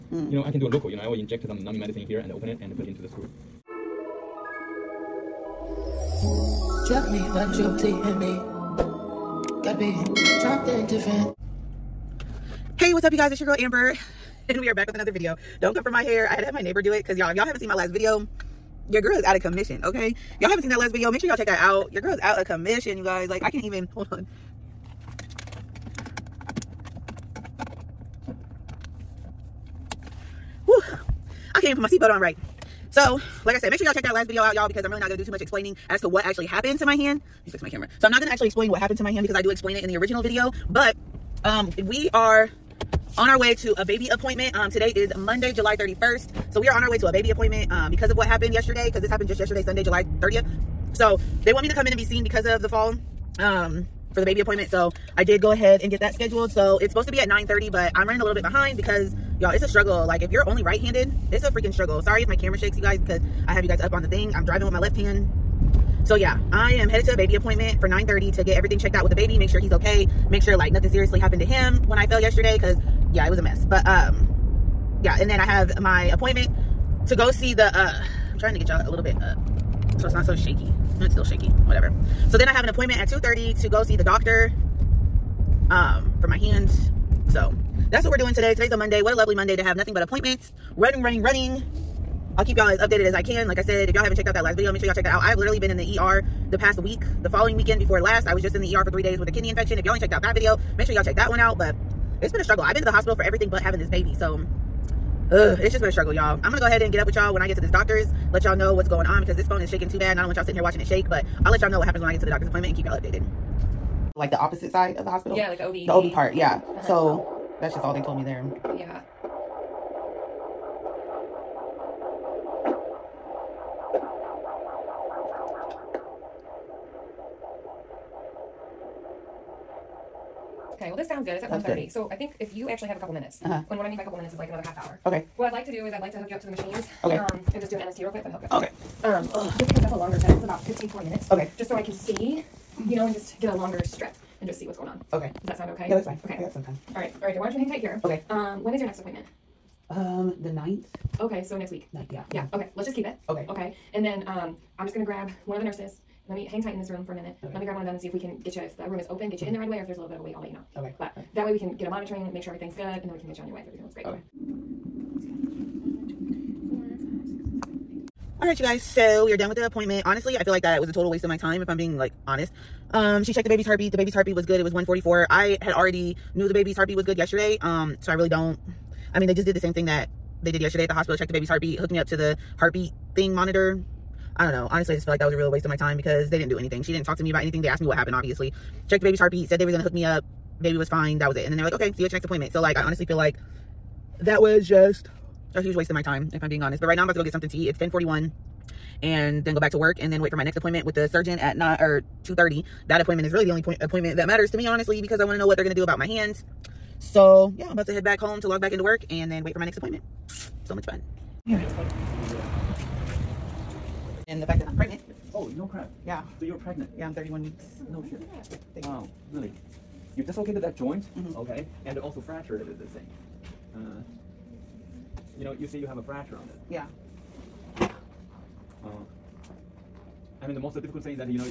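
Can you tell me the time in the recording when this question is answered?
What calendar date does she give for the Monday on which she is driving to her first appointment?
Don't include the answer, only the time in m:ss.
0:45.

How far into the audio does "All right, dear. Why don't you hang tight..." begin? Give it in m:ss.
2:27.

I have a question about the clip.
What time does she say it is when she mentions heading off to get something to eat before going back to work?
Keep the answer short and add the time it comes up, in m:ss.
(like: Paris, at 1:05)
10:41, at 3:17.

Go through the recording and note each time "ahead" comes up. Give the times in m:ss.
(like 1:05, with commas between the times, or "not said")
0:55, 1:46.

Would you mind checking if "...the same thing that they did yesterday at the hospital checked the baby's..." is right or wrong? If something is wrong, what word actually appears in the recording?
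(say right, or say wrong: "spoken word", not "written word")
right.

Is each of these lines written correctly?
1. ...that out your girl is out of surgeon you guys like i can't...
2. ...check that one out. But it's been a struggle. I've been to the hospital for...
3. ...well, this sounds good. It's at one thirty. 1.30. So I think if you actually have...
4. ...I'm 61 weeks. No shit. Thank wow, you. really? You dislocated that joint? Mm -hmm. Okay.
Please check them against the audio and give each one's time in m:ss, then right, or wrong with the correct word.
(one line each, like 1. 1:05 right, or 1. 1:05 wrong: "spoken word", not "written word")
1. 0:21 wrong: "commission", not "surgeon"
2. 1:41 right
3. 2:10 right
4. 3:37 wrong: "31", not "61".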